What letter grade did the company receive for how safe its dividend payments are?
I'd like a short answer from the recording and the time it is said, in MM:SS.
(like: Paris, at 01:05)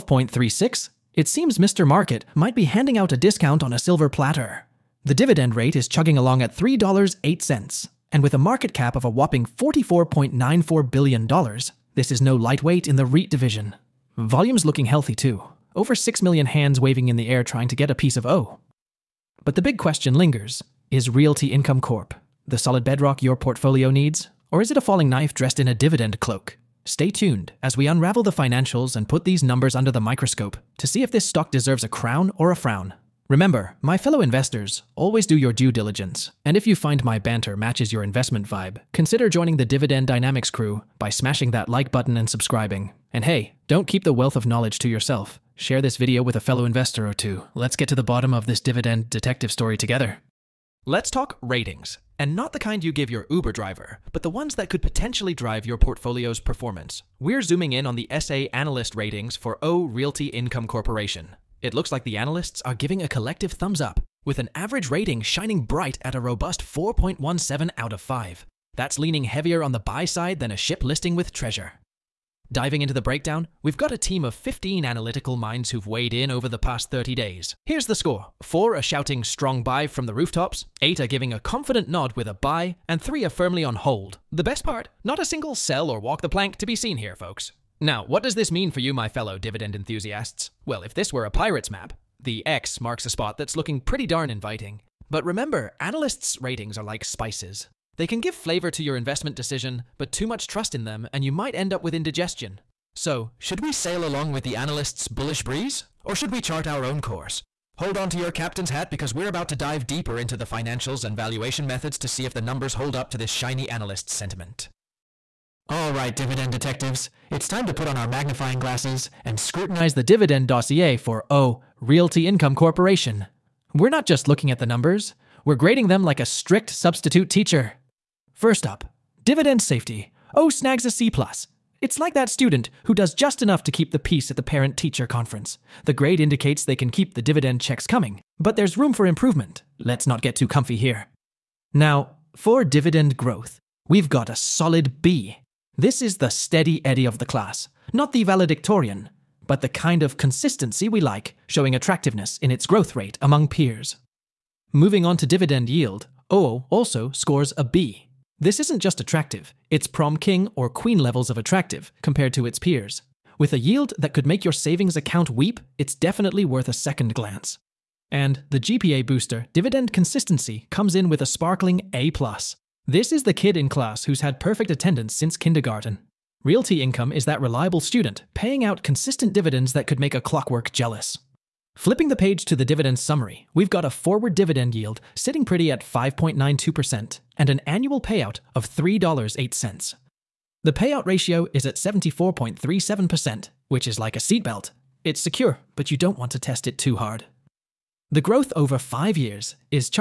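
C+, at 02:10.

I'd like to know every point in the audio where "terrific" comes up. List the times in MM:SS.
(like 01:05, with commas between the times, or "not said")
not said.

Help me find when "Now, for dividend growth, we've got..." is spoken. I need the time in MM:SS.
02:21.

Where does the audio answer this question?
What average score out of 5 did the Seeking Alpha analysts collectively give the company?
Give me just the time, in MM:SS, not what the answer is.
01:06.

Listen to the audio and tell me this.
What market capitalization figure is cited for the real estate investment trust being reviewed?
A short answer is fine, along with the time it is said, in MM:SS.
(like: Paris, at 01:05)
$44.94 billion, at 00:09.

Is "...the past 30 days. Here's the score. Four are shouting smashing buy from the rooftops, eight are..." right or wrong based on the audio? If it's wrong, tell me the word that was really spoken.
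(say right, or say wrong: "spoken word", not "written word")
wrong: "strong", not "smashing".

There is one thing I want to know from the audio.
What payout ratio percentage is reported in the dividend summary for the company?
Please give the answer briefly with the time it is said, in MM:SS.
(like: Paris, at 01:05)
74.37%, at 03:11.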